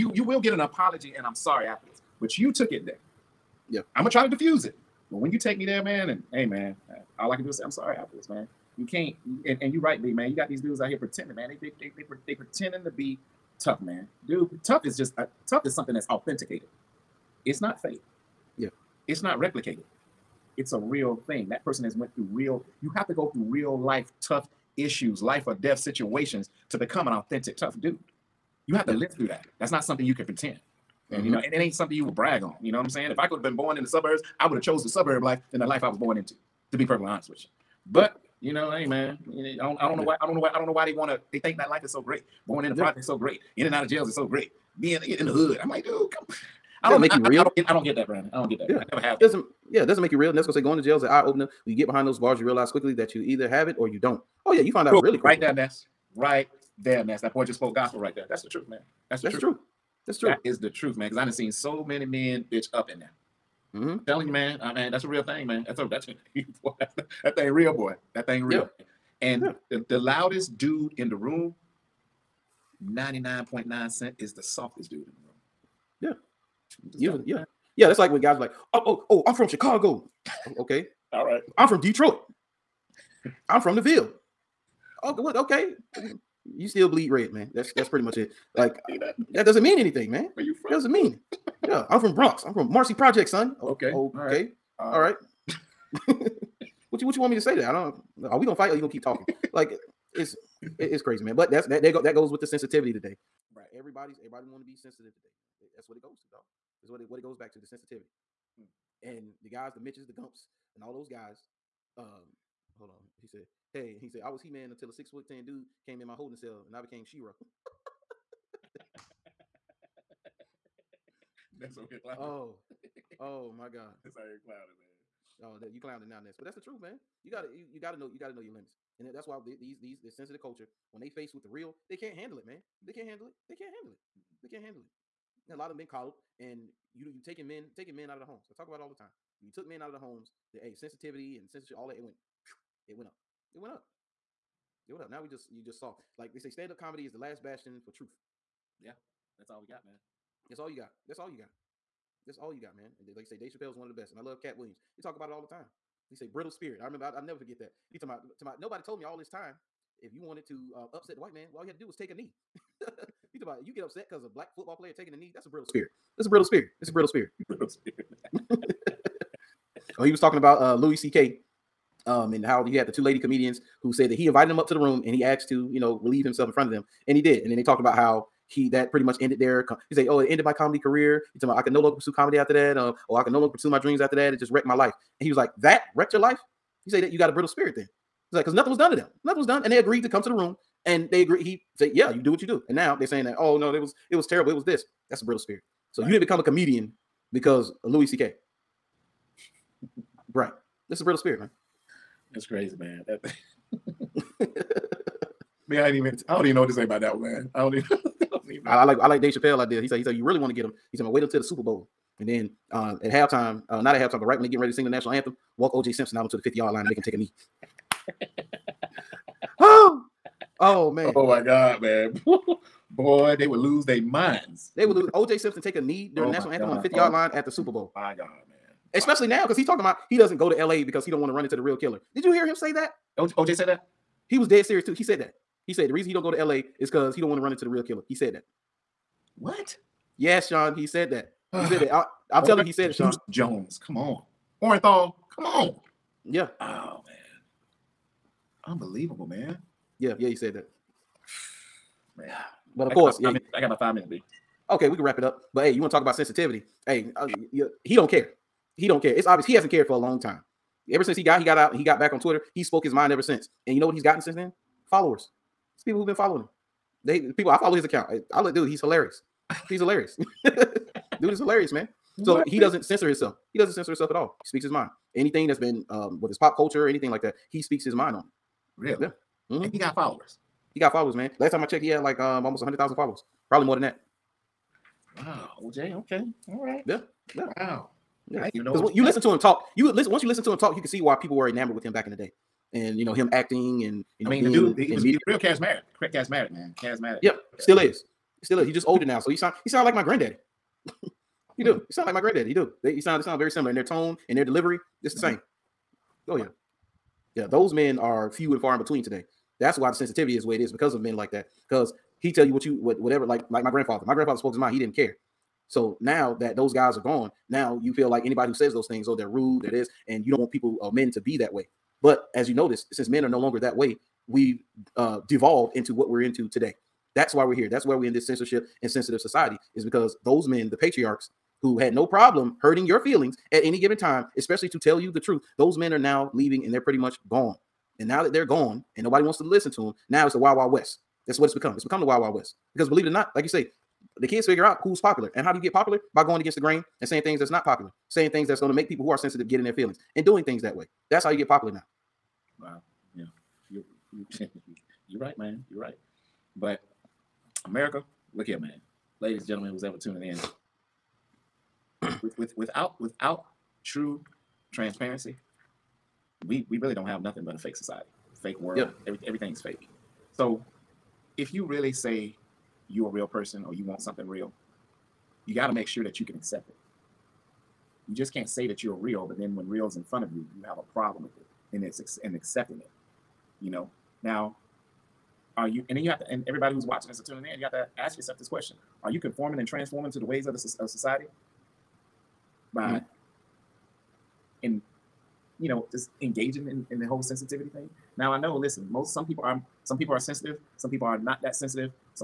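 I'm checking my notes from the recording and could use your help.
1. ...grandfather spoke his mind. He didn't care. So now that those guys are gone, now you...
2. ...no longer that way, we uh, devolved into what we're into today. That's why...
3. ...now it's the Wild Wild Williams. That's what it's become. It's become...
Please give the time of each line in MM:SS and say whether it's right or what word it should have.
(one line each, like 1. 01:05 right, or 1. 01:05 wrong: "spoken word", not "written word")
1. 05:14 right
2. 05:23 right
3. 05:40 wrong: "West", not "Williams".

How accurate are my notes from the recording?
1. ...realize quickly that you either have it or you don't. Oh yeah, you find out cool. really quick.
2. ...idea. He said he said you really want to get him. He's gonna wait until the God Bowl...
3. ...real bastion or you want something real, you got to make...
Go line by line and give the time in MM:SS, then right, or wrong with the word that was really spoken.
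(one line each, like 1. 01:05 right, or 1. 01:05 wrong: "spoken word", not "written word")
1. 00:52 right
2. 03:29 wrong: "Super", not "God"
3. 06:13 wrong: "person", not "bastion".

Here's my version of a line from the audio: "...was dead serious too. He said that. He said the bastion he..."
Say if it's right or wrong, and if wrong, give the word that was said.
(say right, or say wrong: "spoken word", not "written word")
wrong: "reason", not "bastion".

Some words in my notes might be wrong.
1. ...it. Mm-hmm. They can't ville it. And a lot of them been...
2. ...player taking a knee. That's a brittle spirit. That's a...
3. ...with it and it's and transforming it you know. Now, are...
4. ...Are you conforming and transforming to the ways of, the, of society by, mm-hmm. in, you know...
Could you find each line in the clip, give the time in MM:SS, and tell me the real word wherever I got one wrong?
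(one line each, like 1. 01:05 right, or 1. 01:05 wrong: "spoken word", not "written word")
1. 02:13 wrong: "handle", not "ville"
2. 02:44 right
3. 06:21 wrong: "accepting", not "transforming"
4. 06:29 right.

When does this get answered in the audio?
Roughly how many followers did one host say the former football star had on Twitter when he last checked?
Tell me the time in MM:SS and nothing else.
04:42.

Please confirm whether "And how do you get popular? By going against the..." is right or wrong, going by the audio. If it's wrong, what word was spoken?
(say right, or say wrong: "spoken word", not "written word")
right.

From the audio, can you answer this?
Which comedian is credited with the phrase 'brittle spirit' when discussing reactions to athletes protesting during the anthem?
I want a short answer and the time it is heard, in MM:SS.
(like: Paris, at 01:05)
Katt Williams, at 02:34.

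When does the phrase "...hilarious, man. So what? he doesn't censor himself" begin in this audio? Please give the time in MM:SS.
04:31.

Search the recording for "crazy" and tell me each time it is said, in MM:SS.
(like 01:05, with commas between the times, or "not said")
01:41, 03:22.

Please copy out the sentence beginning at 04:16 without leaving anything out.
Hey, uh, you, he don't care.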